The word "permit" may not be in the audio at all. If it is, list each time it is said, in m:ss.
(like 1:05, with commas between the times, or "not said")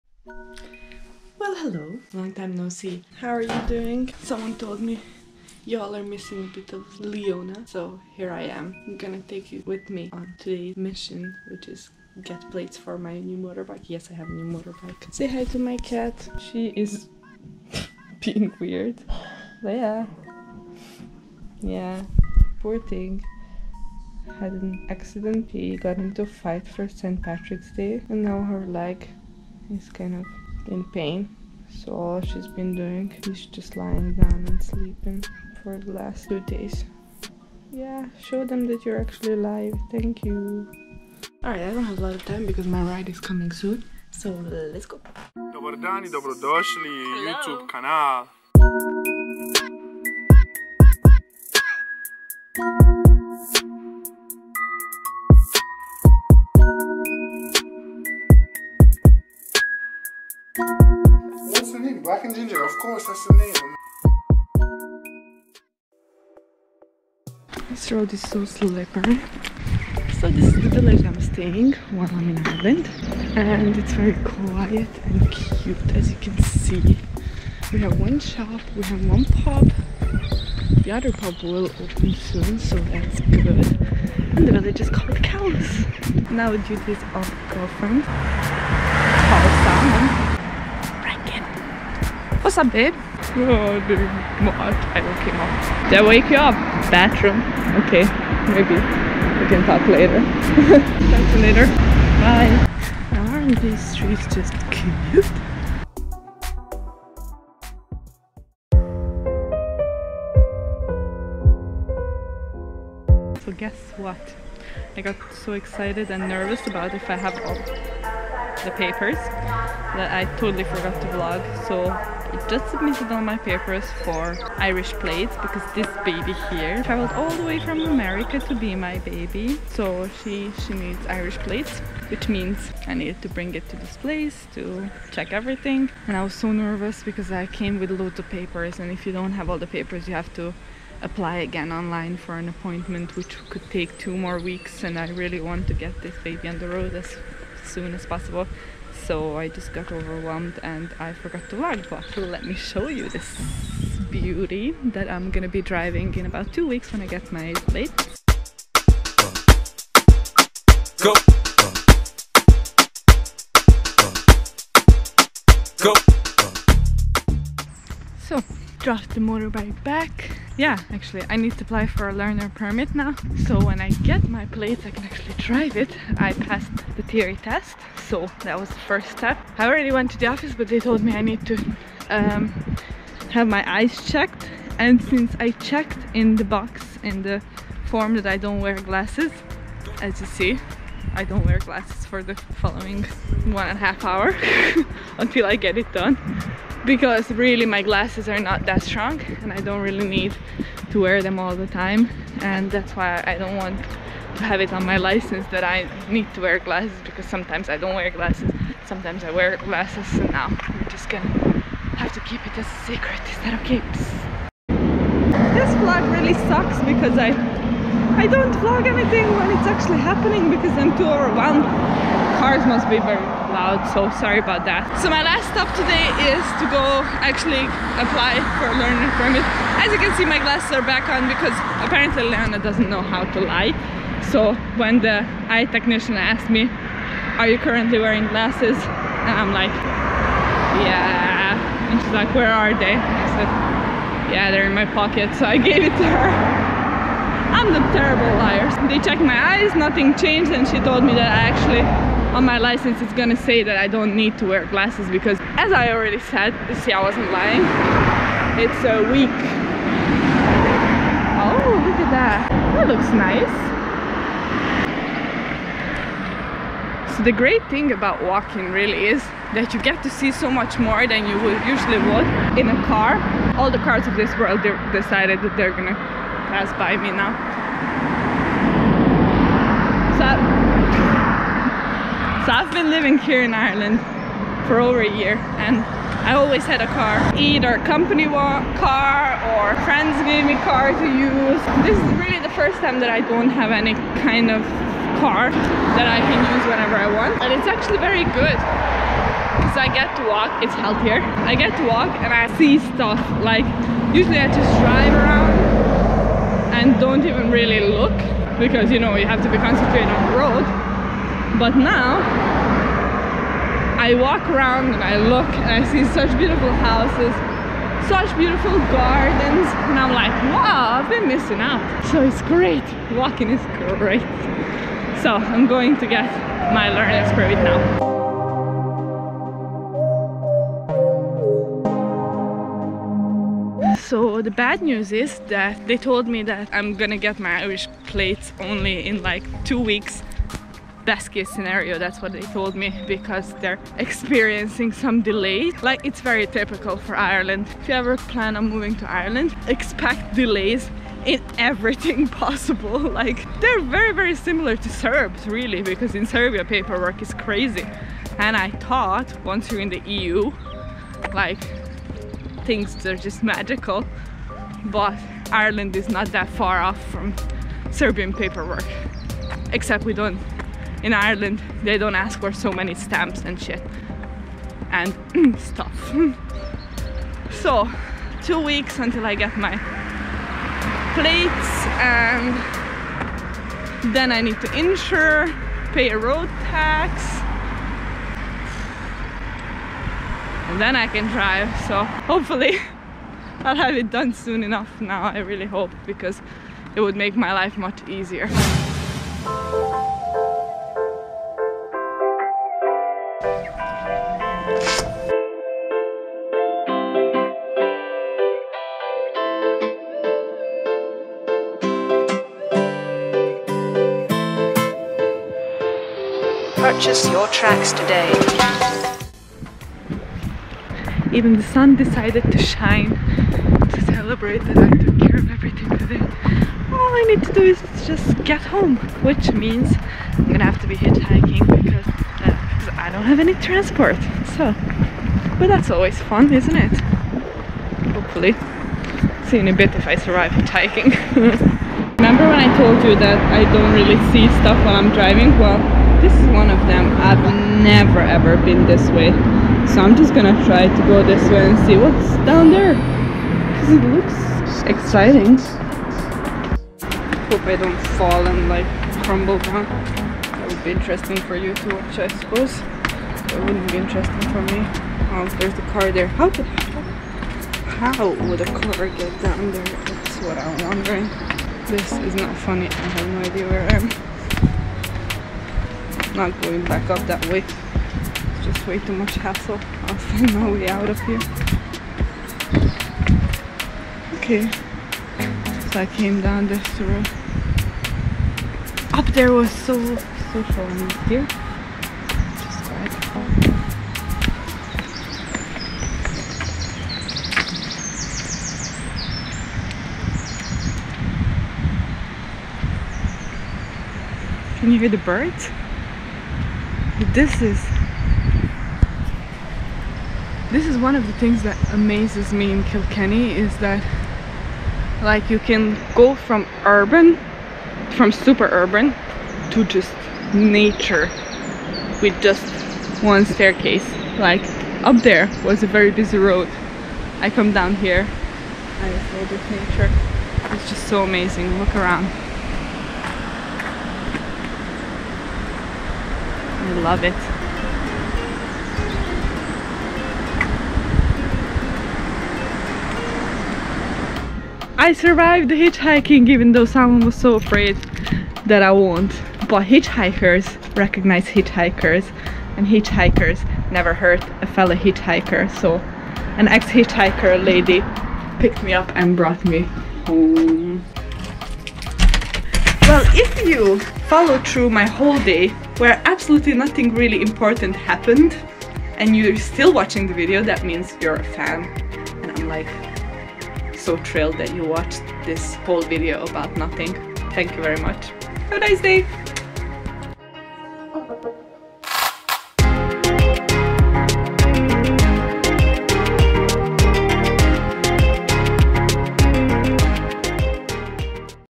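2:52, 3:49, 5:27.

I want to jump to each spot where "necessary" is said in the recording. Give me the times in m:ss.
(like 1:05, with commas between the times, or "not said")
not said.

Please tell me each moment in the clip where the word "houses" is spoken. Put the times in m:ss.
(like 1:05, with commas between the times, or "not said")
5:16.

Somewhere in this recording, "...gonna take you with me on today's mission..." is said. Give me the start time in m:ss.
0:08.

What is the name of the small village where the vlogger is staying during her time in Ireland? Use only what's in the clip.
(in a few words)
Kells.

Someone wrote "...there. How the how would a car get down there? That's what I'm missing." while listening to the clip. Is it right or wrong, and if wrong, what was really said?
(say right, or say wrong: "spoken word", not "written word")
wrong: "wondering", not "missing".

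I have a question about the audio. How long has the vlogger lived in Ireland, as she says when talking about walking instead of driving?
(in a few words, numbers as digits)
over a year.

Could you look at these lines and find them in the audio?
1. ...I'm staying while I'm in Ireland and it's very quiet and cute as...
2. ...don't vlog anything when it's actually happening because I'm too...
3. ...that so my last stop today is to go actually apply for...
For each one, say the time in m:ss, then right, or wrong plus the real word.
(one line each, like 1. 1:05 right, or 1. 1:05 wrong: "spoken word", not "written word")
1. 1:11 right
2. 3:38 right
3. 3:44 right.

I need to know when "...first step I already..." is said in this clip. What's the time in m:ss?
2:58.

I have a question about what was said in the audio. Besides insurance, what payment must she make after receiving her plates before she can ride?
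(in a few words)
road tax.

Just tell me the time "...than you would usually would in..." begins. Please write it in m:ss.
4:31.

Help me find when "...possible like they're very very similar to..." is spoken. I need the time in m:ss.
5:52.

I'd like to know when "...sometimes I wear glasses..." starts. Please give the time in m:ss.
3:28.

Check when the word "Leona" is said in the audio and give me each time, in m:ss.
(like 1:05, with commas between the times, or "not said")
0:06, 3:52.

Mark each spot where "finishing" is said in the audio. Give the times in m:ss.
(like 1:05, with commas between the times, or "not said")
not said.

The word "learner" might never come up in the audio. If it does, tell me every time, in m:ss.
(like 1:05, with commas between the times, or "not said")
2:52, 3:48, 5:26.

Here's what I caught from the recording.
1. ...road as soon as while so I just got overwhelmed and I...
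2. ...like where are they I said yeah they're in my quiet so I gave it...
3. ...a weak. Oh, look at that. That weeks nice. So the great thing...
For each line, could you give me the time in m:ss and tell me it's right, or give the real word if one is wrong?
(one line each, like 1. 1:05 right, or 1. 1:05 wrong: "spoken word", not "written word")
1. 2:26 wrong: "possible", not "while"
2. 4:02 wrong: "pocket", not "quiet"
3. 4:18 wrong: "looks", not "weeks".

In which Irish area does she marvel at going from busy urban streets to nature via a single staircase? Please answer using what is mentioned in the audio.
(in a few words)
Kilkenny.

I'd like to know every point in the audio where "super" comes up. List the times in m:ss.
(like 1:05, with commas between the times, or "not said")
8:38.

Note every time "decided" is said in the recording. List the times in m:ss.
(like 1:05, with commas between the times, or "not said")
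4:34, 7:01.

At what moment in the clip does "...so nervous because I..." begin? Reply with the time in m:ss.
2:16.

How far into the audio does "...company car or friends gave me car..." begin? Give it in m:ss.
4:47.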